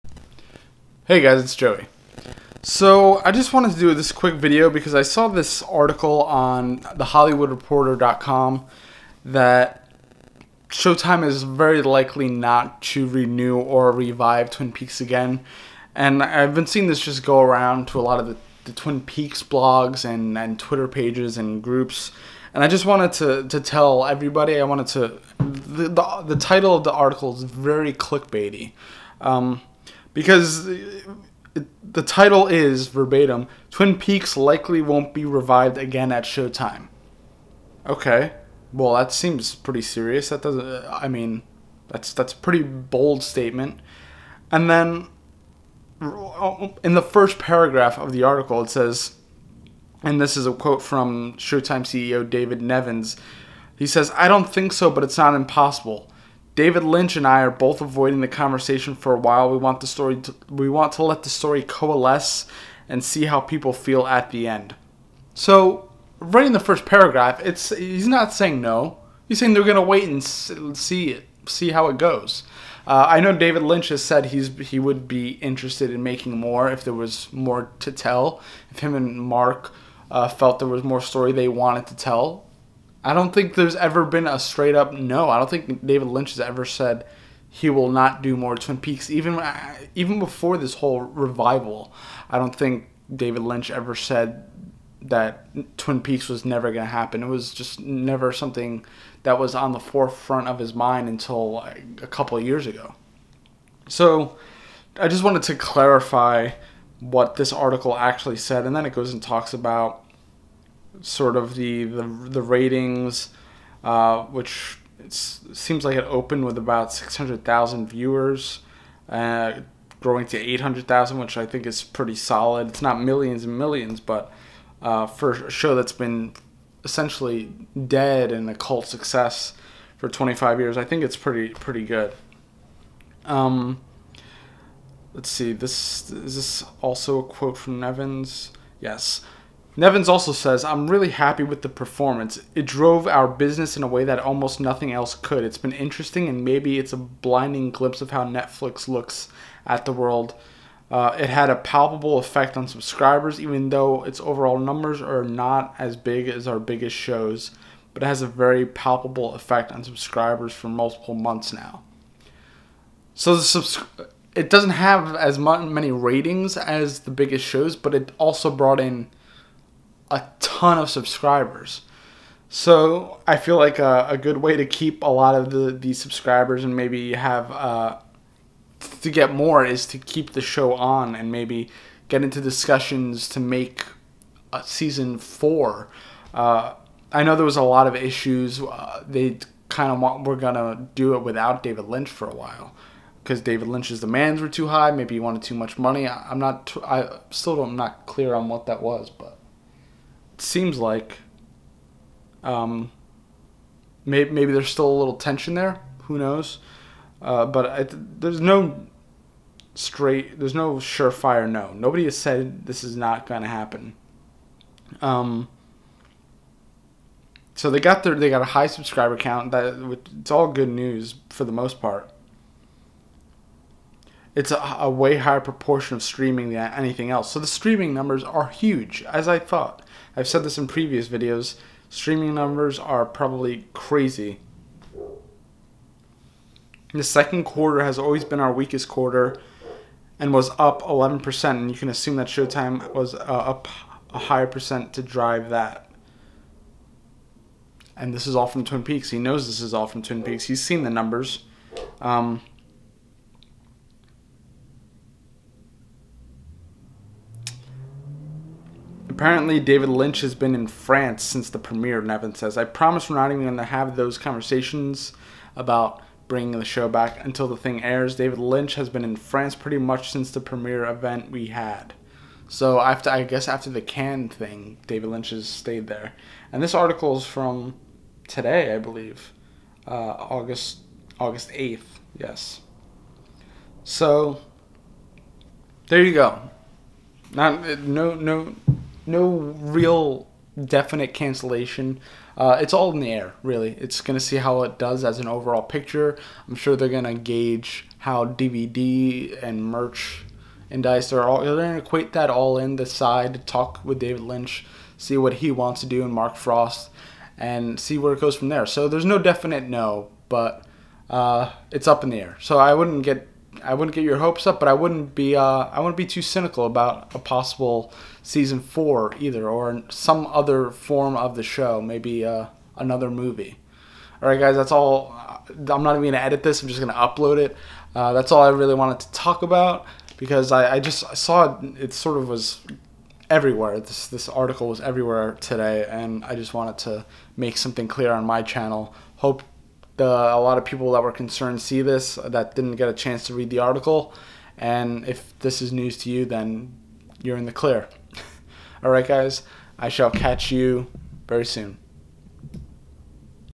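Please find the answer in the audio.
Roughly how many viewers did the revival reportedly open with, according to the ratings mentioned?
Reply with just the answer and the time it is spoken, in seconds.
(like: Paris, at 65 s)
600,000, at 116 s.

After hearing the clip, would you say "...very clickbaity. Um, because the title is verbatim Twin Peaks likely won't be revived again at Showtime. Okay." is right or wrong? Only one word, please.
right.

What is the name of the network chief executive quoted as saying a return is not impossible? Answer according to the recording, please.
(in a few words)
David Nevins.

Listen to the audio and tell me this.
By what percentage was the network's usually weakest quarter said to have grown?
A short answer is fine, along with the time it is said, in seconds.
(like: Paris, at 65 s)
11%, at 240 s.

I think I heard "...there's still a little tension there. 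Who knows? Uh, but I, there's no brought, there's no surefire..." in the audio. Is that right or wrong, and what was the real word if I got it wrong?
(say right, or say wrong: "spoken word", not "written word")
wrong: "straight", not "brought".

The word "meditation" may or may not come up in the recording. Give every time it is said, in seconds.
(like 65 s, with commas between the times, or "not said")
not said.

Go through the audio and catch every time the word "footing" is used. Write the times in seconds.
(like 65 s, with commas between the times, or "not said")
not said.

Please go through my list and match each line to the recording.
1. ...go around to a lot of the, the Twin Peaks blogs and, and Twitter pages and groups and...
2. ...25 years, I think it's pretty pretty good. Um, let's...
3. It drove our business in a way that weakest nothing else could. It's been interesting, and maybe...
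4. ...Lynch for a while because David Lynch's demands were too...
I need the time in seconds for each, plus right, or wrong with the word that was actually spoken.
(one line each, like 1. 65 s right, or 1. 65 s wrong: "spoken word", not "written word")
1. 17 s right
2. 130 s right
3. 142 s wrong: "almost", not "weakest"
4. 191 s right.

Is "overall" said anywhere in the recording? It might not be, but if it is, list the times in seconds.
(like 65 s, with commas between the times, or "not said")
154 s, 295 s.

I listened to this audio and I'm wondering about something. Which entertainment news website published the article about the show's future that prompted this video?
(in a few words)
thehollywoodreporter.com.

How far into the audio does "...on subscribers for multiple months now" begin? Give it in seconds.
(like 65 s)
159 s.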